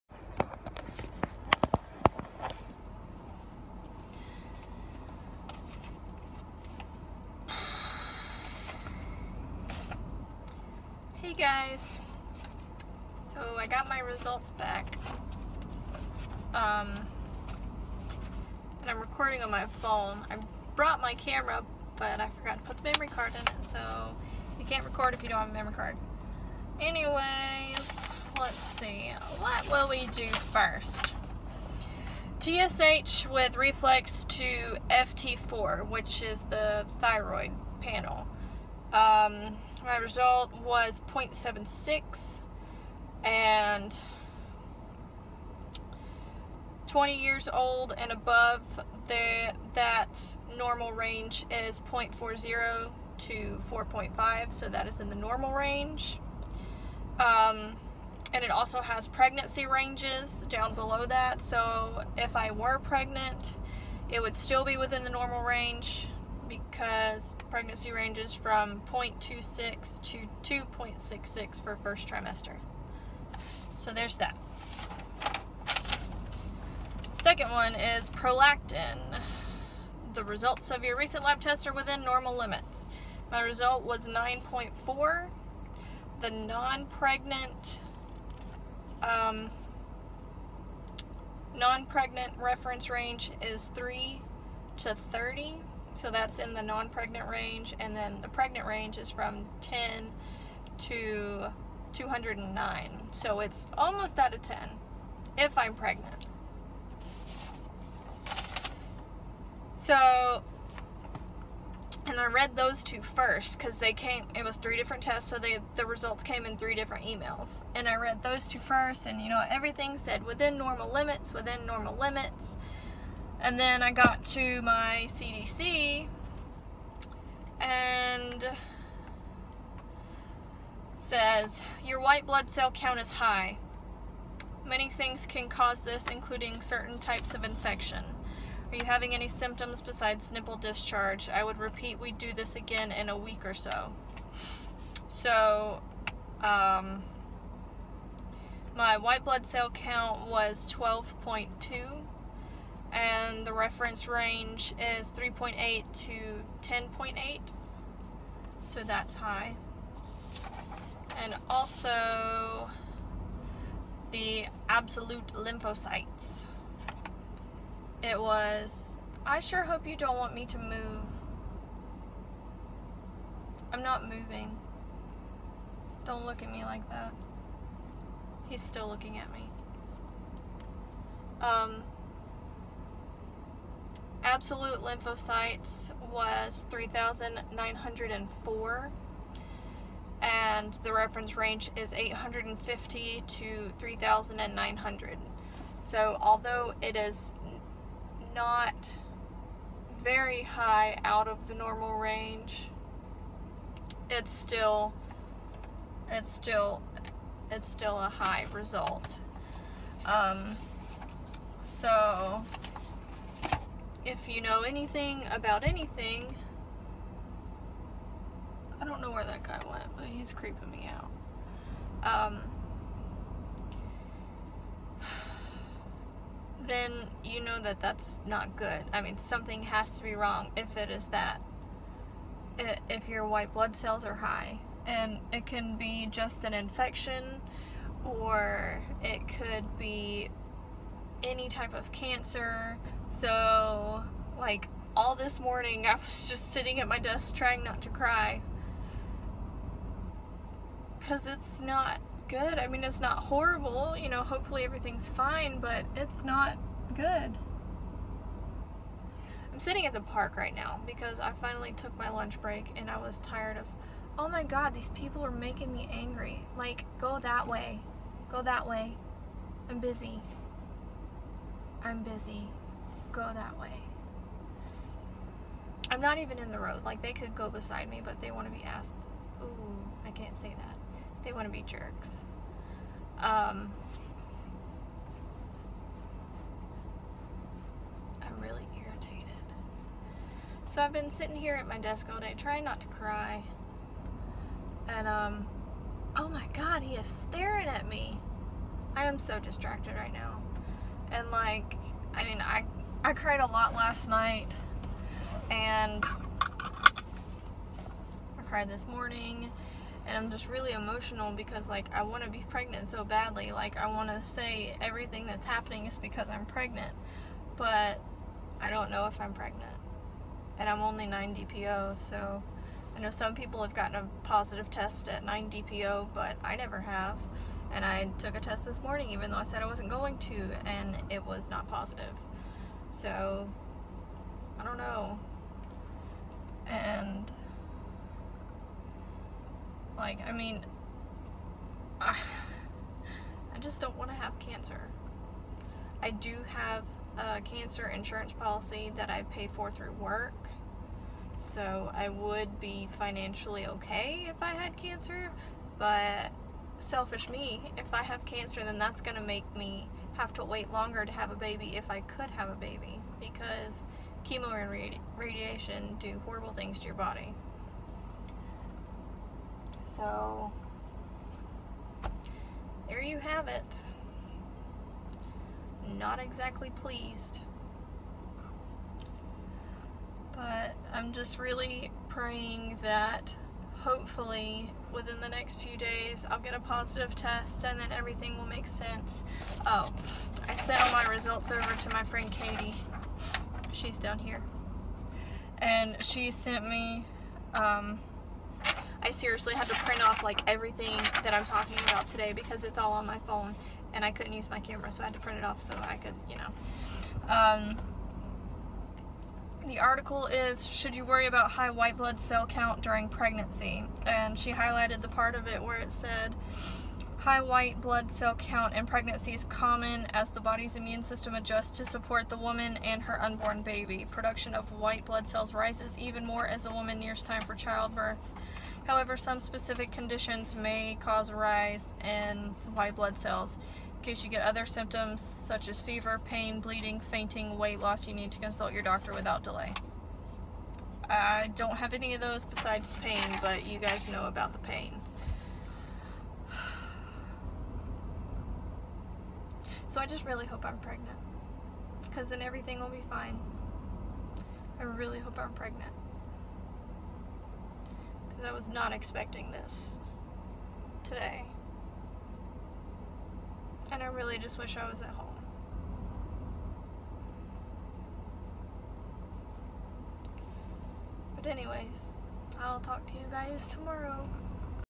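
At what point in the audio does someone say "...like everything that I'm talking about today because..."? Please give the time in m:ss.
6:40.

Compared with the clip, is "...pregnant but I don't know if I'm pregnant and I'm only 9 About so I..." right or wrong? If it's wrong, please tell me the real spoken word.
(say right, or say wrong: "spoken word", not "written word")
wrong: "DPO", not "About".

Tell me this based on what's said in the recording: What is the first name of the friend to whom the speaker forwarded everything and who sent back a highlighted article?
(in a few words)
Katie.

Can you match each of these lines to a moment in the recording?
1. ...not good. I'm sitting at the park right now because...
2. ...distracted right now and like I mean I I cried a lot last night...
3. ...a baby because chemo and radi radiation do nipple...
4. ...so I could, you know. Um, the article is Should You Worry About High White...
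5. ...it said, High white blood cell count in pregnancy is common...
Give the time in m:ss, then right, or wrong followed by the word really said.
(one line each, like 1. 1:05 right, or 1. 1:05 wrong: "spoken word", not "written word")
1. 4:16 right
2. 4:59 right
3. 6:02 wrong: "horrible", not "nipple"
4. 6:45 right
5. 6:55 right.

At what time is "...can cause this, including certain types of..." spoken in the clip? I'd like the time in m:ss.
2:15.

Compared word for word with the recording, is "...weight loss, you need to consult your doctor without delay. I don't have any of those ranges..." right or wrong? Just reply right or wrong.
wrong.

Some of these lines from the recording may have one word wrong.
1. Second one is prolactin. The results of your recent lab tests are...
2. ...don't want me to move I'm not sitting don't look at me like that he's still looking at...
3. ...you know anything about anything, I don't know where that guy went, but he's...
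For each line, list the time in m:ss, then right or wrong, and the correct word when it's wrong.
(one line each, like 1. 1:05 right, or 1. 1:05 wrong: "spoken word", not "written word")
1. 1:17 right
2. 2:49 wrong: "moving", not "sitting"
3. 3:34 right.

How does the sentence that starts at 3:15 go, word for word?
So although it is not very high out of the normal range, it's still, it's still, it's still a high result.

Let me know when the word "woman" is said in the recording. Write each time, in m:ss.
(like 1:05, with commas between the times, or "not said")
7:02, 7:06.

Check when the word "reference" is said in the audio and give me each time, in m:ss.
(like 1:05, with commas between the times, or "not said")
1:32, 2:33, 3:10.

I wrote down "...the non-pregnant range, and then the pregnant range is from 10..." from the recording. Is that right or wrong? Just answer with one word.
right.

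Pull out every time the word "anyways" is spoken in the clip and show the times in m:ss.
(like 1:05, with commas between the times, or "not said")
0:26, 7:51.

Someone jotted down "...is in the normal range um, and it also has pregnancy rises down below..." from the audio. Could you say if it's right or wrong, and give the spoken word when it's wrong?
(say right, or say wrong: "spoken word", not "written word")
wrong: "ranges", not "rises".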